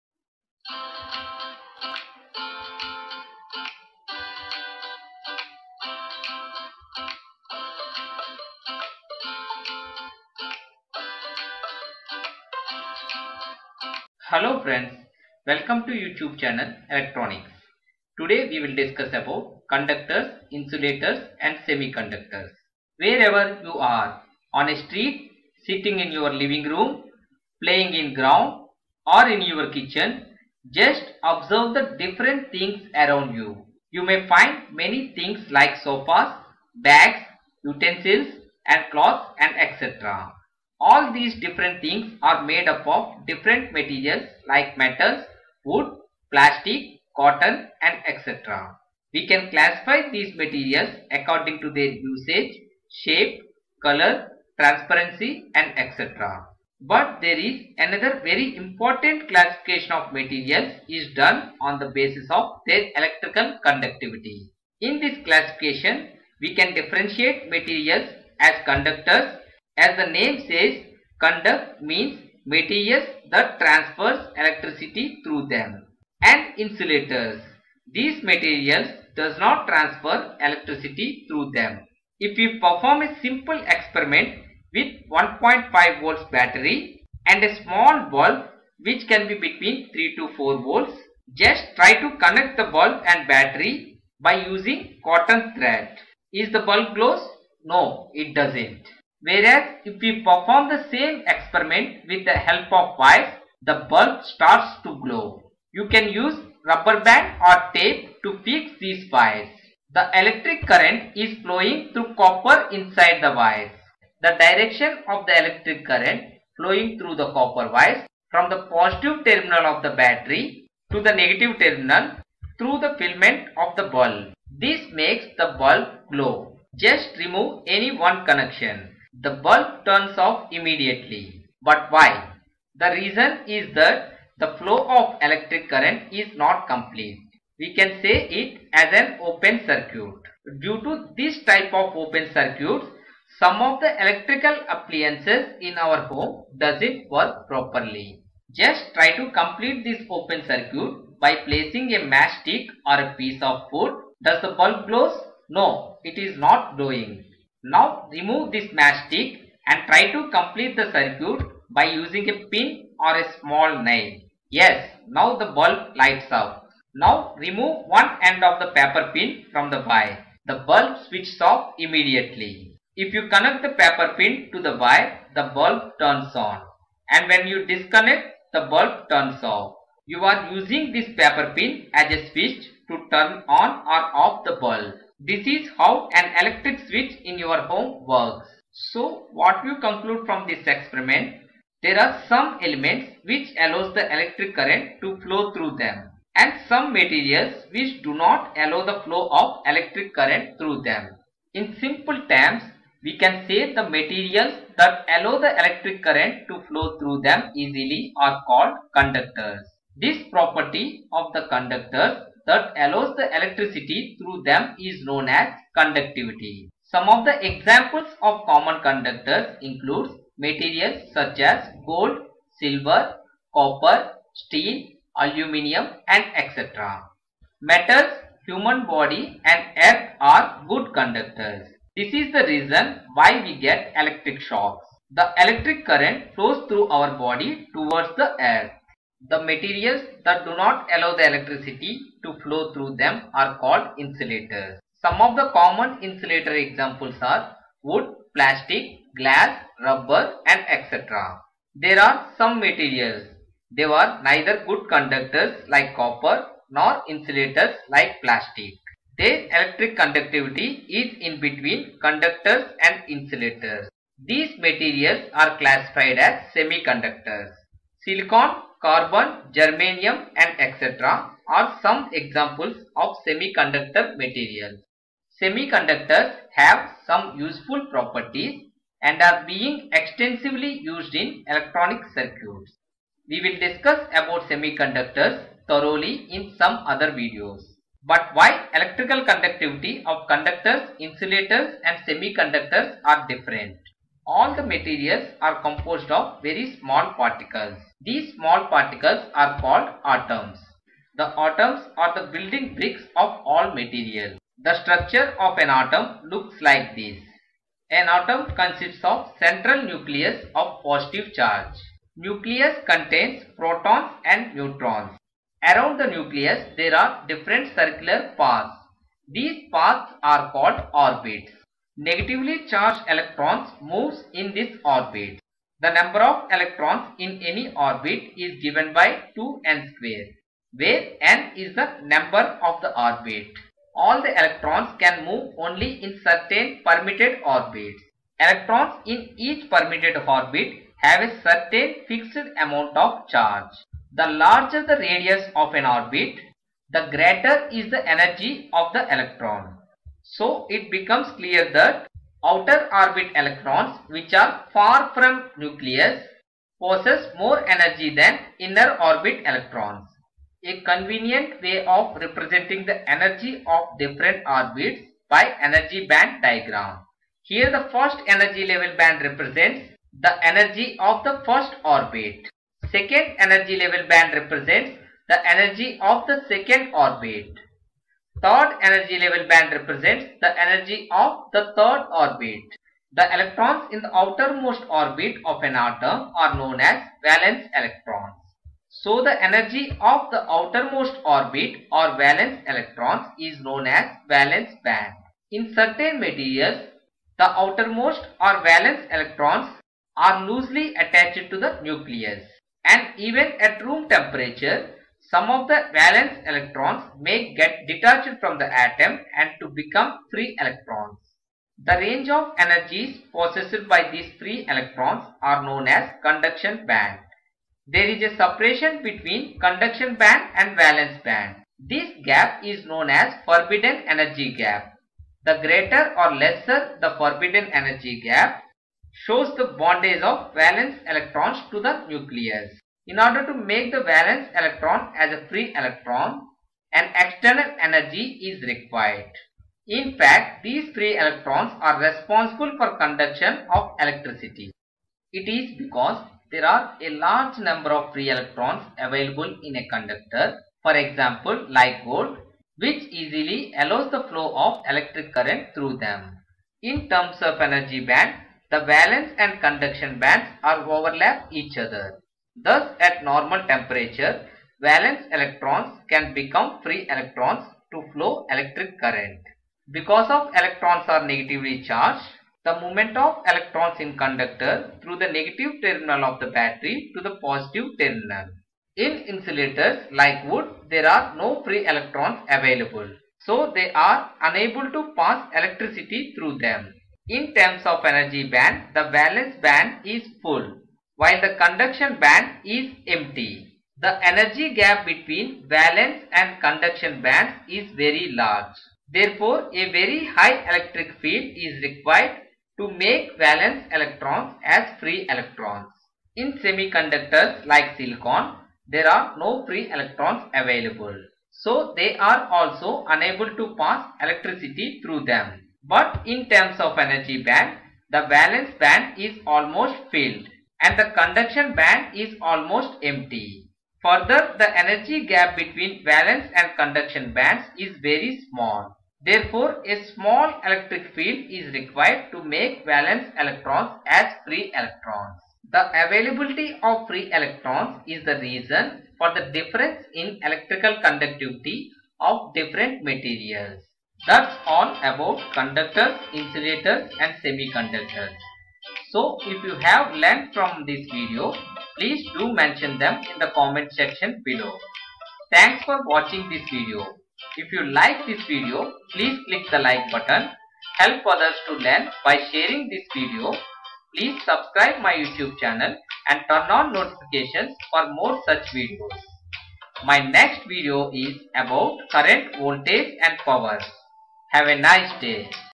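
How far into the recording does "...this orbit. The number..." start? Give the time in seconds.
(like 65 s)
324 s.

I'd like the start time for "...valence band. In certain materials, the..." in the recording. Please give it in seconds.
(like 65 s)
394 s.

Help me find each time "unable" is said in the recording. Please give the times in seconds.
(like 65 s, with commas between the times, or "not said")
484 s, 513 s.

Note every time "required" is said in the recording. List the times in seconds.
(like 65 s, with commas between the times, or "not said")
438 s, 501 s, 531 s.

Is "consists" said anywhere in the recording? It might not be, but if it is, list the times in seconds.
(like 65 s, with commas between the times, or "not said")
308 s.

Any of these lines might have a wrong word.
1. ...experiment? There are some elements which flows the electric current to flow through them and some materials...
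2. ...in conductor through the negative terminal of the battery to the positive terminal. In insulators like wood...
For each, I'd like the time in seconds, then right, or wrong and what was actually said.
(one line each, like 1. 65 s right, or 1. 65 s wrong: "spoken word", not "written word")
1. 190 s wrong: "allows", not "flows"
2. 473 s right.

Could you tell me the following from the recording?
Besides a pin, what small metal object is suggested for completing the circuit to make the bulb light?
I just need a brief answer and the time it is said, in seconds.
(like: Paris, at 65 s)
A small nail, at 163 s.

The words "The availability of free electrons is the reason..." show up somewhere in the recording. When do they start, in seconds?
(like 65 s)
535 s.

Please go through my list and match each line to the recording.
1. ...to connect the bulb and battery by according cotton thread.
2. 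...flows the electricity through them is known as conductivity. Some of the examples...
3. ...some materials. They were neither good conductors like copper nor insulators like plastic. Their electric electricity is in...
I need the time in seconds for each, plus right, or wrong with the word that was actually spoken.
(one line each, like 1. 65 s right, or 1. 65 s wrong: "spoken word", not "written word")
1. 91 s wrong: "using", not "according"
2. 212 s wrong: "allows", not "flows"
3. 252 s wrong: "conductivity", not "electricity".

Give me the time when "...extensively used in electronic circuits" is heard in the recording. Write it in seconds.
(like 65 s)
279 s.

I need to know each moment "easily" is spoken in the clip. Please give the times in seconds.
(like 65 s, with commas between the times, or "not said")
207 s, 453 s.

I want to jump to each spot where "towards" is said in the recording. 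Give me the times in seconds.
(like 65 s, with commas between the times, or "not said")
237 s.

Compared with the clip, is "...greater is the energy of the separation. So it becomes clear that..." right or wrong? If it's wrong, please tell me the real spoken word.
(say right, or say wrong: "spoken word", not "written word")
wrong: "electron", not "separation".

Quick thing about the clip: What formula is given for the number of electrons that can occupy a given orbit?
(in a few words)
2n squared.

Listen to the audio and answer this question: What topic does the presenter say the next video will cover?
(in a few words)
Current, voltage and power.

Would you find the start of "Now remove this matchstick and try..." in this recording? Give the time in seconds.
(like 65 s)
157 s.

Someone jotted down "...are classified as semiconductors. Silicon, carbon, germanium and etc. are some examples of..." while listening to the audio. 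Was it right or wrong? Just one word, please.
right.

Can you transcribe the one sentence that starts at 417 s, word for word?
There is a separation between conduction band and valence band.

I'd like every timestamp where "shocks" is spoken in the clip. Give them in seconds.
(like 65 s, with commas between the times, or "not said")
234 s.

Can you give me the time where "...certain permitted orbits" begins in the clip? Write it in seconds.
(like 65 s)
336 s.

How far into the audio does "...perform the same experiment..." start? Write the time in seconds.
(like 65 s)
100 s.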